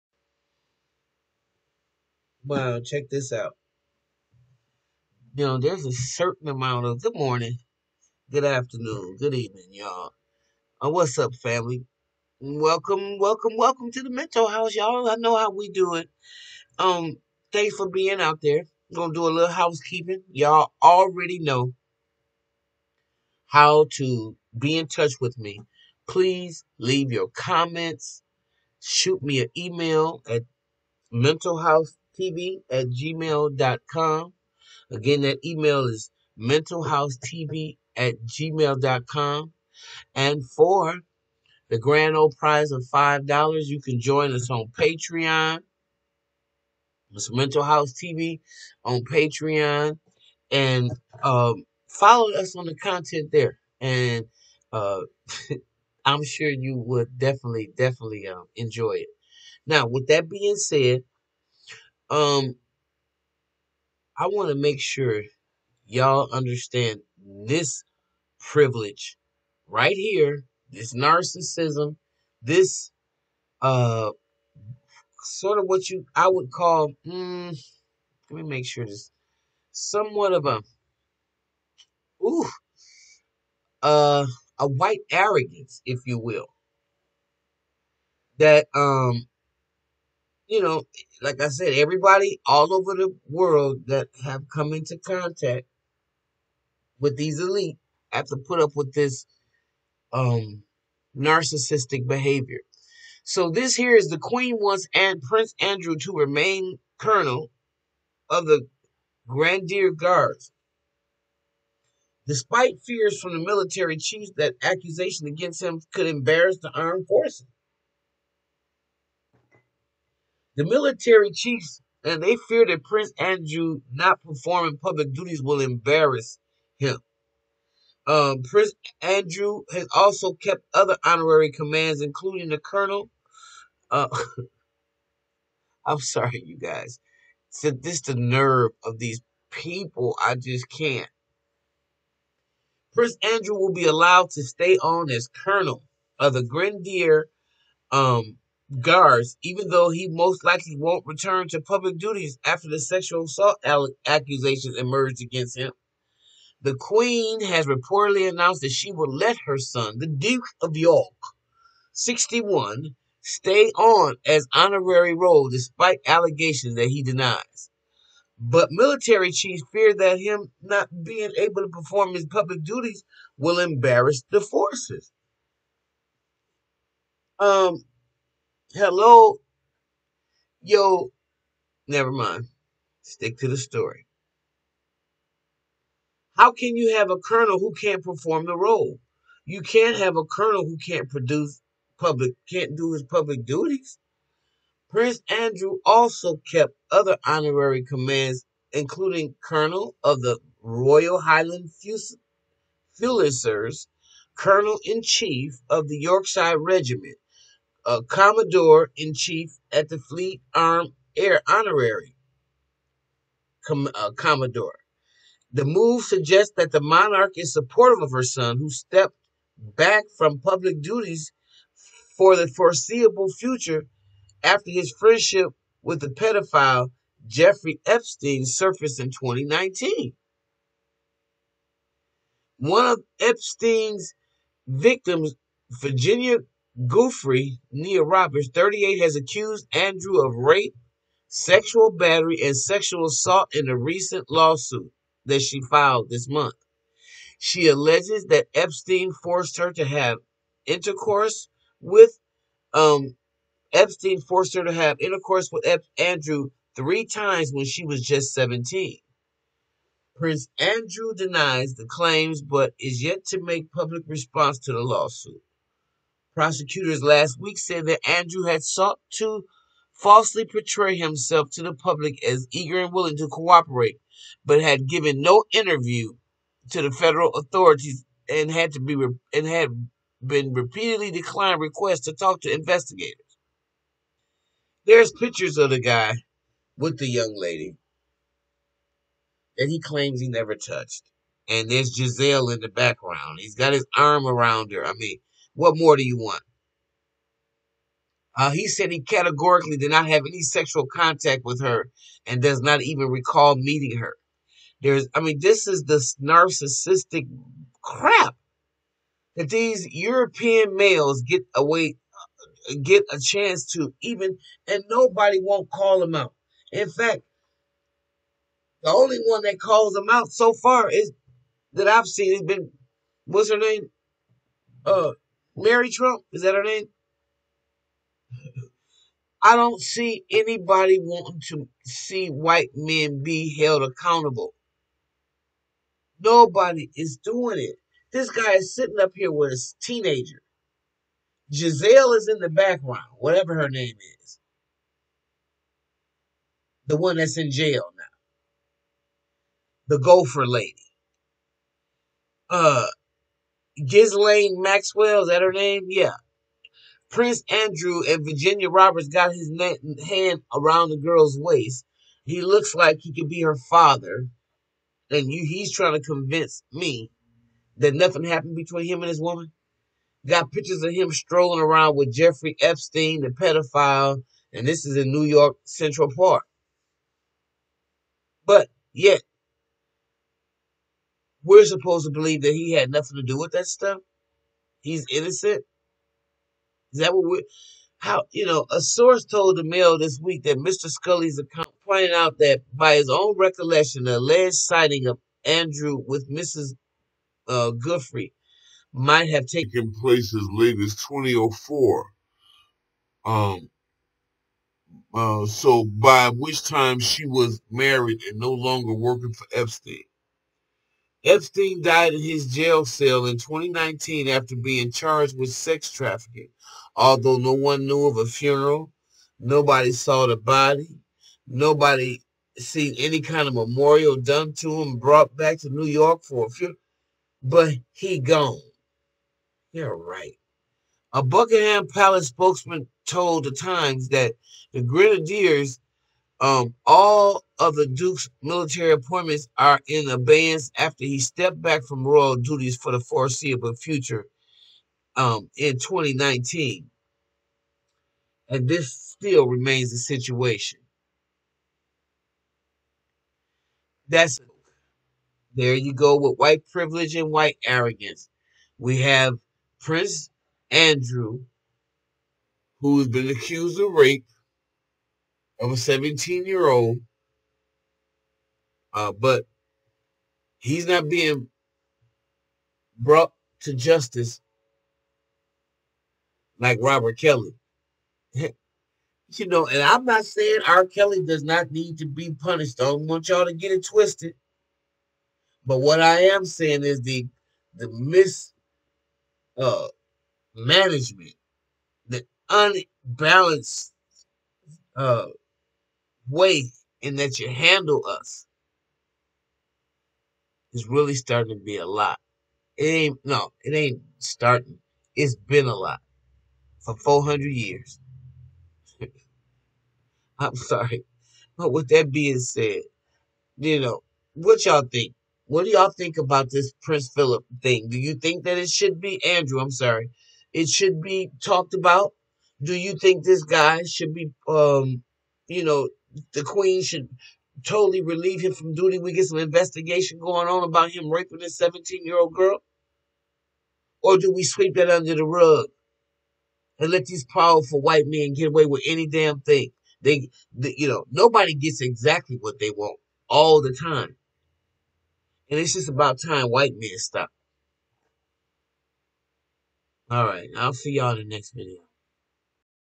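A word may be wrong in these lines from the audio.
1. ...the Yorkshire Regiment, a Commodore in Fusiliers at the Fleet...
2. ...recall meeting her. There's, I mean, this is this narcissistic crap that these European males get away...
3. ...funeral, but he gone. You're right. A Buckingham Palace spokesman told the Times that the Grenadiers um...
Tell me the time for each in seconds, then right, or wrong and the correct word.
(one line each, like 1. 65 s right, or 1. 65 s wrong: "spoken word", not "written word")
1. 205 s wrong: "Chief", not "Fusiliers"
2. 303 s right
3. 426 s right.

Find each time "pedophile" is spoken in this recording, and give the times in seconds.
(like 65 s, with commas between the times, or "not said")
226 s, 373 s.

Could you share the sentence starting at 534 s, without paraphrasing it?
Or do we sweep that under the rug and let these powerful white men get away with any damn thing?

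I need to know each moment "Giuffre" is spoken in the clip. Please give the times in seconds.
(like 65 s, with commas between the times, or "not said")
236 s, 397 s.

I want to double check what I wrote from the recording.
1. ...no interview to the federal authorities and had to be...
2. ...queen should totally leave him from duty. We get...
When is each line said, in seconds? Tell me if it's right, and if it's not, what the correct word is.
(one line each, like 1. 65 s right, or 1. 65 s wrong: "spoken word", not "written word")
1. 275 s right
2. 526 s wrong: "relieve", not "leave".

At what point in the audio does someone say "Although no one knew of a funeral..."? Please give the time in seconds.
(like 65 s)
416 s.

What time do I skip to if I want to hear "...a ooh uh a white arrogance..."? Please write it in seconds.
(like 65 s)
80 s.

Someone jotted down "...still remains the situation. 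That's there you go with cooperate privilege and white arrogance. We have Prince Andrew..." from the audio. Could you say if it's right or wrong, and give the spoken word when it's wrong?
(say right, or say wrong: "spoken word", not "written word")
wrong: "white", not "cooperate".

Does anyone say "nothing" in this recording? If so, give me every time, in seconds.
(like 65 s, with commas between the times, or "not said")
367 s, 382 s.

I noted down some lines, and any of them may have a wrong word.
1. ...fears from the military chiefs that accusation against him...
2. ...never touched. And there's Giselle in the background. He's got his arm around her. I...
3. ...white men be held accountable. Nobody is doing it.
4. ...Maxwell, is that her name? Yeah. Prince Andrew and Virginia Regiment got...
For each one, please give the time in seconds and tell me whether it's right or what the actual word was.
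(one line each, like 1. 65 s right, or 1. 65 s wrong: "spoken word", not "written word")
1. 112 s right
2. 290 s right
3. 332 s right
4. 354 s wrong: "Roberts", not "Regiment".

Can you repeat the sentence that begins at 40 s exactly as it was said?
And for the grand old prize of $5, you can join us on Patreon.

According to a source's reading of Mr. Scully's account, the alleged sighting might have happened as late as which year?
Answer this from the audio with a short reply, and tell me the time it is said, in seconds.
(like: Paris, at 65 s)
2004, at 401 s.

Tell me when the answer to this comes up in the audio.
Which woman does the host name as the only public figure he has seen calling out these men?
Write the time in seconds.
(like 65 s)
325 s.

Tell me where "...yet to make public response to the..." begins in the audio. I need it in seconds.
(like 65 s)
263 s.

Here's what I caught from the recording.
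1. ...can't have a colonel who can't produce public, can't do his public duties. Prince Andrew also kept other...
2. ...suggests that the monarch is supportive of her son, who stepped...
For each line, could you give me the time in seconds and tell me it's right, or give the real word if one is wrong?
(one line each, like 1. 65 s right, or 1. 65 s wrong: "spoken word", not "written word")
1. 189 s right
2. 216 s right.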